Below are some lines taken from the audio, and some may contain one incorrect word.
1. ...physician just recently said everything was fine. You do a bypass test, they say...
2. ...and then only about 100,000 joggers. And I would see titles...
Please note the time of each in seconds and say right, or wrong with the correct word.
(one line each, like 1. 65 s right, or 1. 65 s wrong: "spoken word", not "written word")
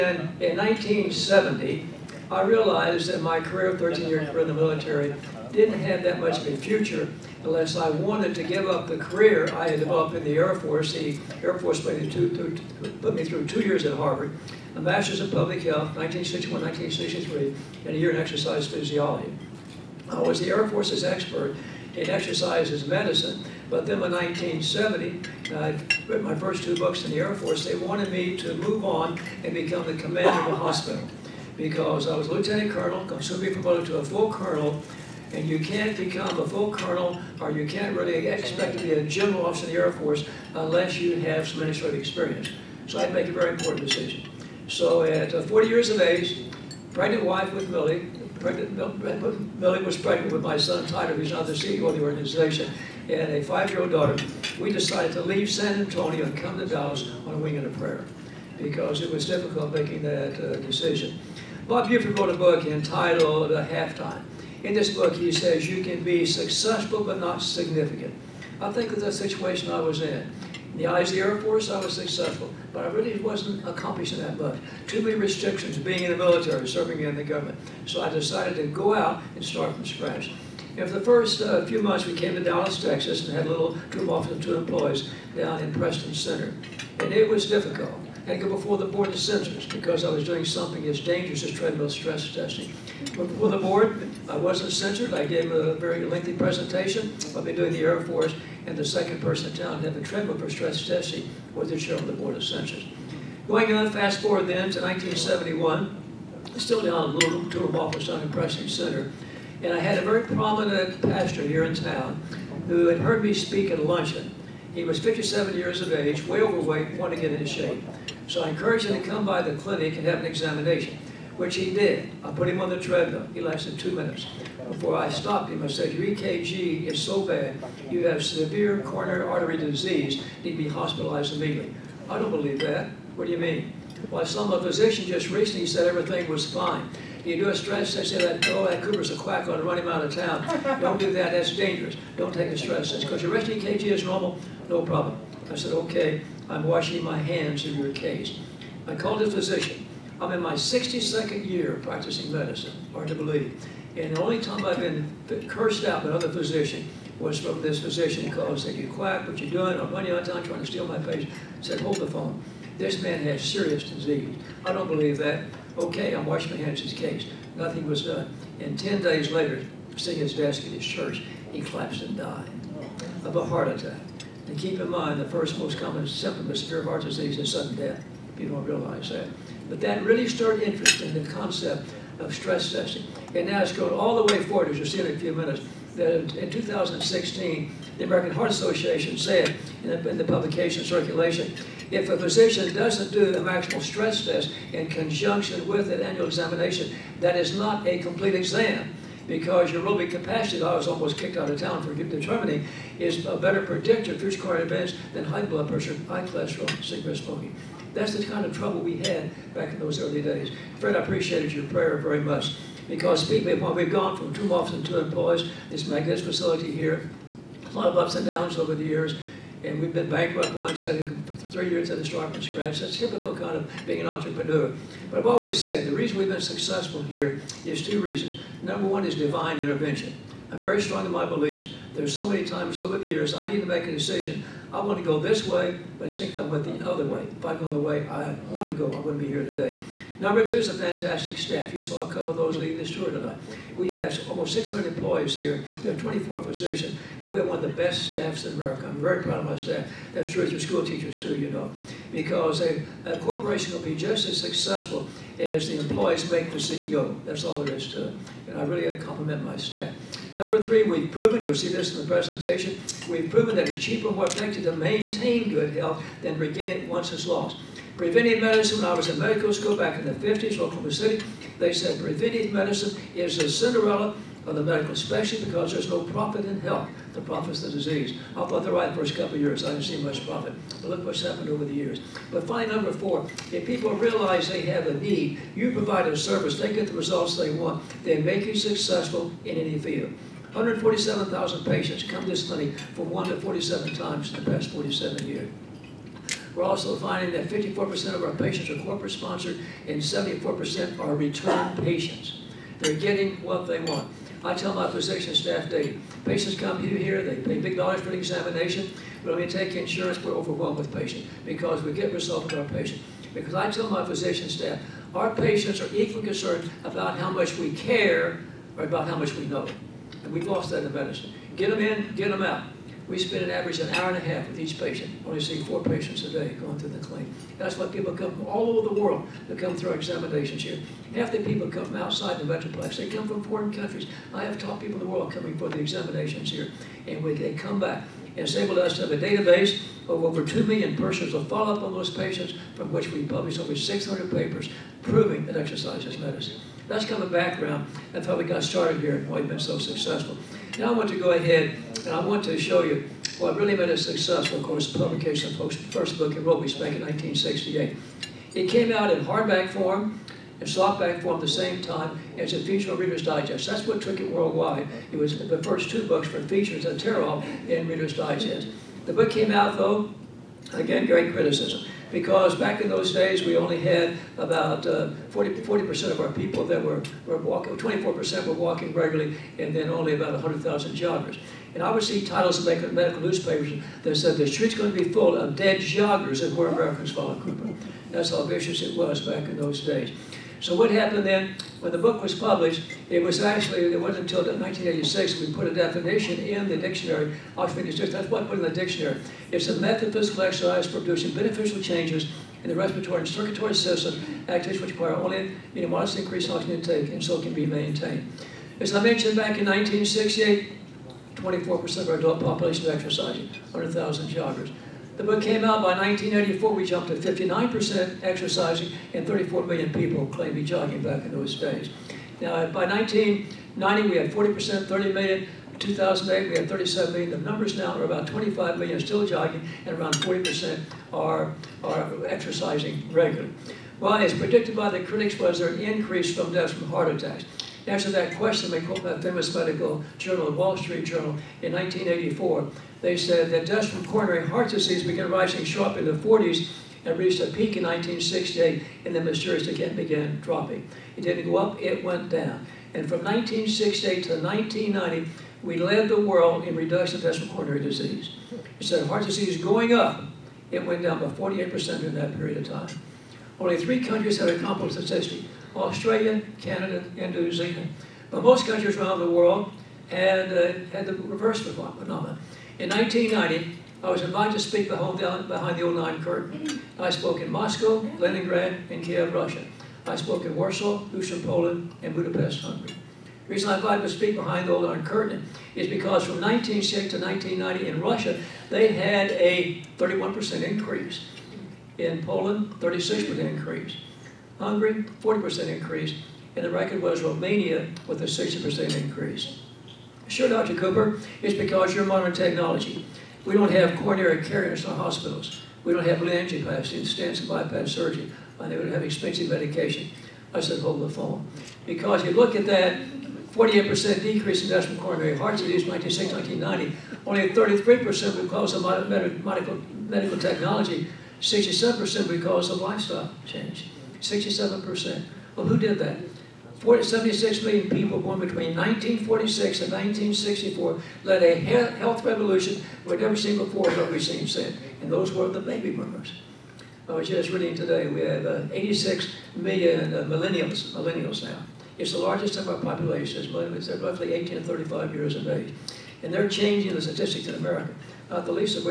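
1. 134 s wrong: "stress", not "bypass"
2. 379 s right.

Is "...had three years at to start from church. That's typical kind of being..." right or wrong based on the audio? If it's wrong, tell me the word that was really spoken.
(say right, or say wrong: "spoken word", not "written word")
wrong: "scratch", not "church".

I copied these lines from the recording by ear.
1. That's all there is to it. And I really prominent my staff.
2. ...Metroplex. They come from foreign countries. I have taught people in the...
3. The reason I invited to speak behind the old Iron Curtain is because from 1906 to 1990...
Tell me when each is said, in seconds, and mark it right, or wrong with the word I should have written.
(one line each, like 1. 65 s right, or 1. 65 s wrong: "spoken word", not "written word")
1. 257 s wrong: "compliment", not "prominent"
2. 332 s right
3. 483 s right.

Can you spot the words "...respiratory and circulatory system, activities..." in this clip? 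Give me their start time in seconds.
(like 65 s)
402 s.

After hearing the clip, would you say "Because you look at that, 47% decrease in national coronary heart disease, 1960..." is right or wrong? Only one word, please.
wrong.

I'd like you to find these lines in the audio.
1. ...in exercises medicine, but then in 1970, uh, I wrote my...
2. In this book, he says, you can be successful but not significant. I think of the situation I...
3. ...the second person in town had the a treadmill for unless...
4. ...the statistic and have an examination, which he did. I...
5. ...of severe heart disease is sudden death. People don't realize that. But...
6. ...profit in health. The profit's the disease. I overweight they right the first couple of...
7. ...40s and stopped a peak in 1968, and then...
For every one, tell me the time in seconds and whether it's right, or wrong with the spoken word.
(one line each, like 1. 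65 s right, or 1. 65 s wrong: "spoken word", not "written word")
1. 21 s right
2. 64 s right
3. 98 s wrong: "stress", not "unless"
4. 119 s wrong: "clinic", not "statistic"
5. 176 s right
6. 276 s wrong: "thought", not "overweight"
7. 446 s wrong: "reached", not "stopped".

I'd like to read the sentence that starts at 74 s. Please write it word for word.
Too many restrictions being in the military, serving in the government.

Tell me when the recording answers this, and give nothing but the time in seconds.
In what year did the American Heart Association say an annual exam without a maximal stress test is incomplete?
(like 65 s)
186 s.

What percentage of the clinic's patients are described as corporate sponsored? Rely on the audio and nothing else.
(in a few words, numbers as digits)
54%.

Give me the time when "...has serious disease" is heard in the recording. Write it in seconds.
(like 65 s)
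163 s.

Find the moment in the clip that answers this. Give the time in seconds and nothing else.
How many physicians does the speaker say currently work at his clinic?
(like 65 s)
245 s.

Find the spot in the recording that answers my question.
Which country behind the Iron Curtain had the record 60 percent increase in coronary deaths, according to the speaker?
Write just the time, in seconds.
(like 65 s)
497 s.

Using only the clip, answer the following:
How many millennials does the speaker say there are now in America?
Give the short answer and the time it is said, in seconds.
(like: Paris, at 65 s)
86 million, at 538 s.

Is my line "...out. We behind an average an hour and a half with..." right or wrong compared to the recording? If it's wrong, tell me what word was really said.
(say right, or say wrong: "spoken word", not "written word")
wrong: "spend", not "behind".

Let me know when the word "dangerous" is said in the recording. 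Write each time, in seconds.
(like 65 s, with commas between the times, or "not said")
90 s, 141 s.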